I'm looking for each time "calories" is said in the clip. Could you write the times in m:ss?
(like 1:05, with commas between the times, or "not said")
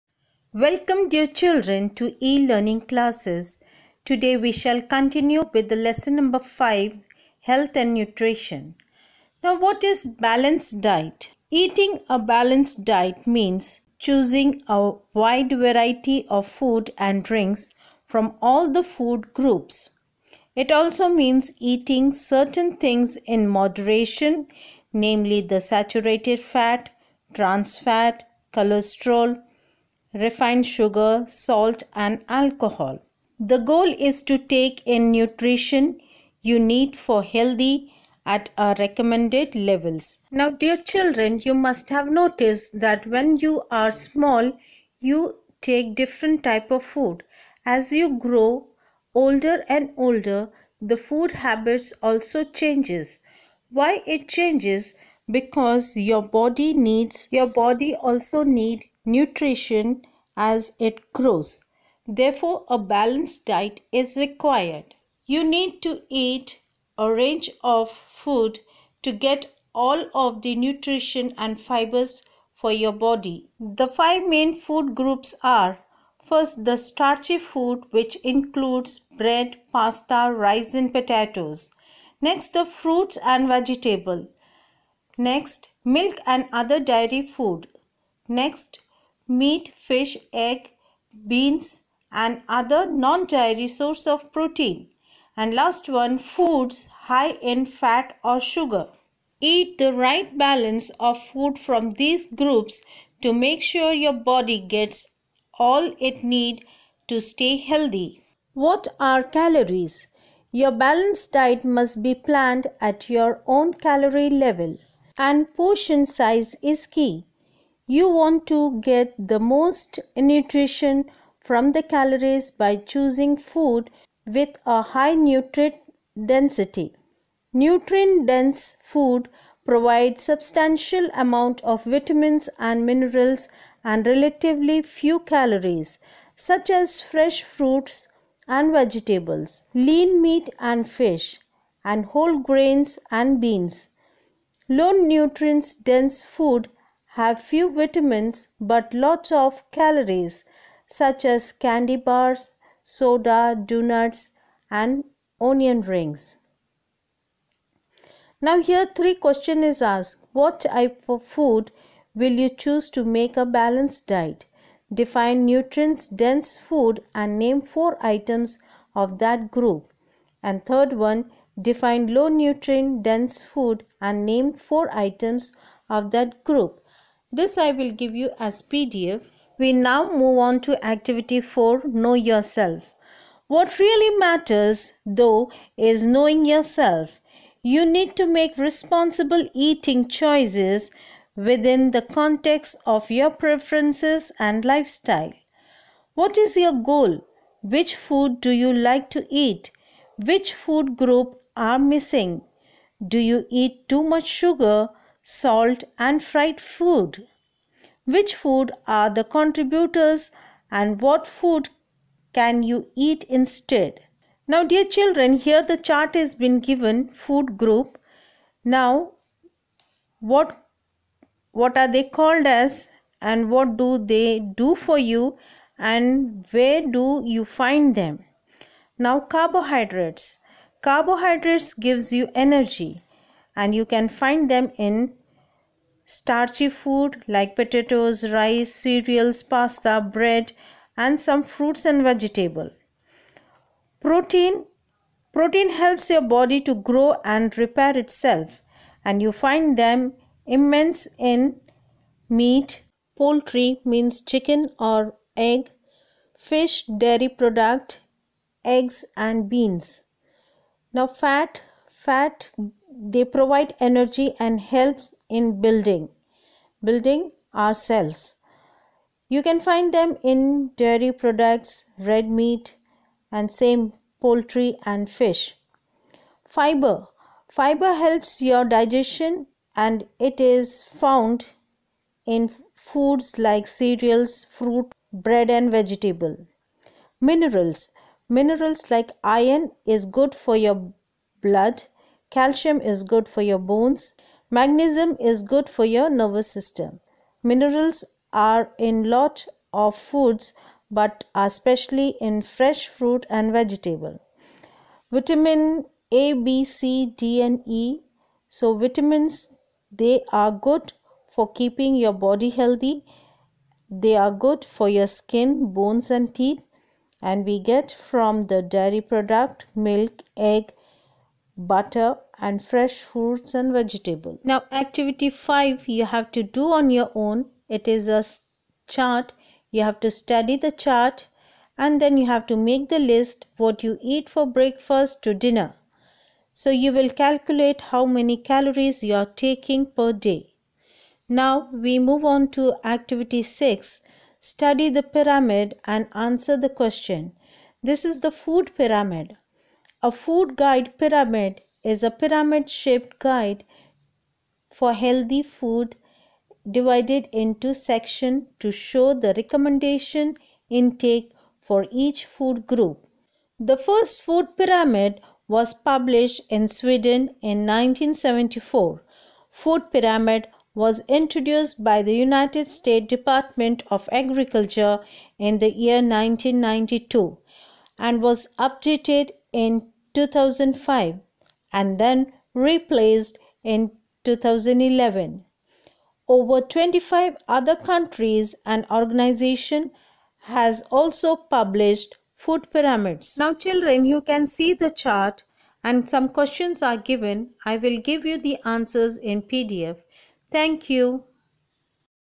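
1:49, 1:53, 2:01, 2:15, 2:29, 5:38.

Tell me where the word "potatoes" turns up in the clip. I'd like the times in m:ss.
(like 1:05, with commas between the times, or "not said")
1:20, 3:57.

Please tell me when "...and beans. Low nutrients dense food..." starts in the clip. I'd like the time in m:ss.
2:23.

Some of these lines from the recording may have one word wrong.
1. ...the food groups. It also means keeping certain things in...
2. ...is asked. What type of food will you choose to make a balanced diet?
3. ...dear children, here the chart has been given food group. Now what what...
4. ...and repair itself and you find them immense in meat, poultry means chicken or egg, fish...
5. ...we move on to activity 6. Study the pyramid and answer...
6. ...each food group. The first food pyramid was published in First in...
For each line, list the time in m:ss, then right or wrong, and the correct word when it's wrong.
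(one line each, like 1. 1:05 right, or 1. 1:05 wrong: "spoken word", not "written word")
1. 0:18 wrong: "eating", not "keeping"
2. 2:39 right
3. 3:34 right
4. 4:07 right
5. 5:41 right
6. 6:01 wrong: "Sweden", not "First".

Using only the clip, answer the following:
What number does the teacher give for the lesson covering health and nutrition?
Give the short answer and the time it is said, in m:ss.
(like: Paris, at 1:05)
5, at 0:05.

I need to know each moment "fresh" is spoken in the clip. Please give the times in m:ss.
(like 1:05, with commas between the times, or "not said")
2:17, 5:02, 5:22.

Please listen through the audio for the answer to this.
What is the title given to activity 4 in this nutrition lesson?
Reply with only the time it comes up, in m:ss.
3:01.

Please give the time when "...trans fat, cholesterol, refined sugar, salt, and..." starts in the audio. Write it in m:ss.
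0:27.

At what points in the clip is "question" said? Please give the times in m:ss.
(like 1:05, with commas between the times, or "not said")
2:39, 5:46, 6:36.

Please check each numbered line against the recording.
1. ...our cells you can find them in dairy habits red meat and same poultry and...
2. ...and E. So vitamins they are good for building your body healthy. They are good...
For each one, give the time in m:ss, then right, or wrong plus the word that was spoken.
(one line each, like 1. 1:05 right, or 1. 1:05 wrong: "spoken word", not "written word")
1. 4:27 wrong: "products", not "habits"
2. 5:07 wrong: "keeping", not "building".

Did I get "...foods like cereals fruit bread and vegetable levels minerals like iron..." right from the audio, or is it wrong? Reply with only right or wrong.
wrong.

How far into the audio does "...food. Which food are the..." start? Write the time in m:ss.
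3:26.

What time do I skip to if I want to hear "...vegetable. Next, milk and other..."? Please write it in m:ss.
1:23.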